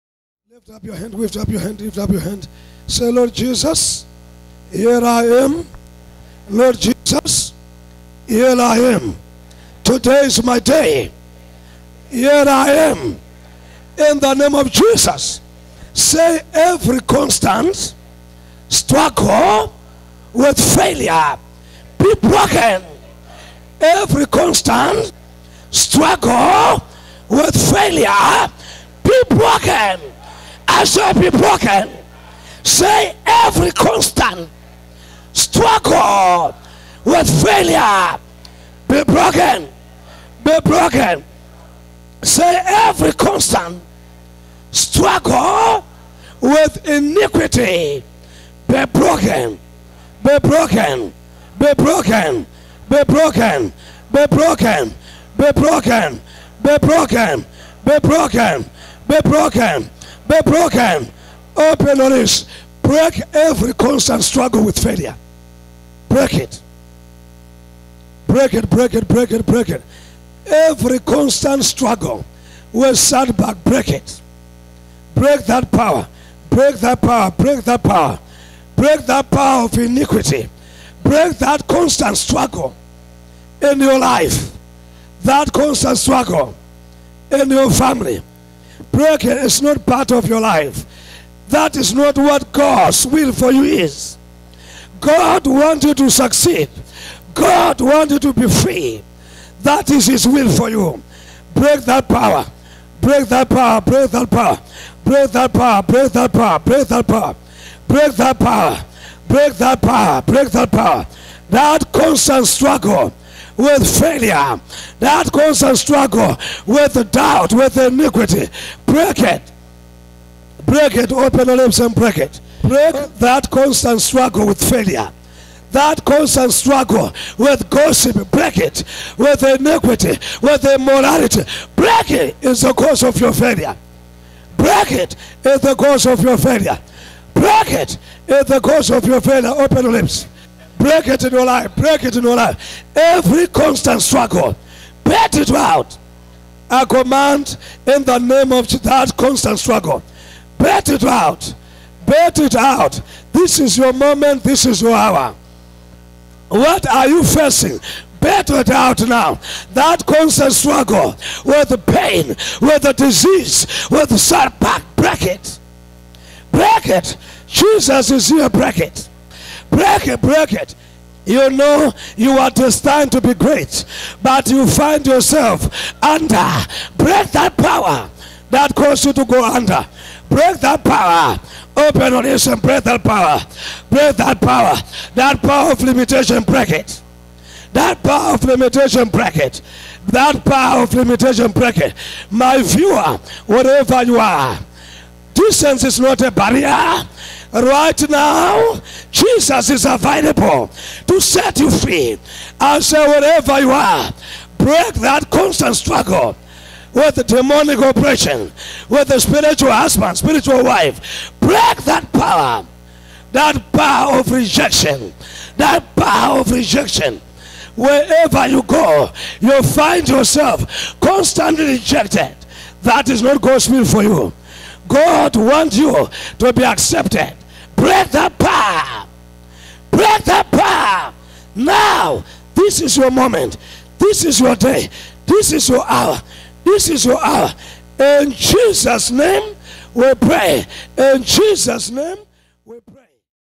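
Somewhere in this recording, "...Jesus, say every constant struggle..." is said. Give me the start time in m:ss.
0:14.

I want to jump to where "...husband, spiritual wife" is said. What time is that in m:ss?
3:29.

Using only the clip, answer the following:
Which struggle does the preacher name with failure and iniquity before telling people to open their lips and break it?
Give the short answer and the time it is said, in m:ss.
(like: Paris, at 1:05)
doubt, at 1:57.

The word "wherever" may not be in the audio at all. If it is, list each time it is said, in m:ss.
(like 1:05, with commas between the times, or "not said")
3:23, 3:37.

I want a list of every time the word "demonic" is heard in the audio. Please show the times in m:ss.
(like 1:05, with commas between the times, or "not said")
3:27.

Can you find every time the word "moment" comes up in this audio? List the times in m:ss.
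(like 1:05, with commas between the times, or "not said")
2:33, 3:53.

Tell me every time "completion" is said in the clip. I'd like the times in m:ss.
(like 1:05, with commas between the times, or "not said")
not said.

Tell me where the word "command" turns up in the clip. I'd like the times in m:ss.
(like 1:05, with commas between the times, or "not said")
2:26.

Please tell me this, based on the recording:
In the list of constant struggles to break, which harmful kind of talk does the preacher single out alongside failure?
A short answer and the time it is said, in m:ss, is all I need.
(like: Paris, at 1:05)
gossip, at 2:07.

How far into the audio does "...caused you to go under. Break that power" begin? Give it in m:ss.
2:58.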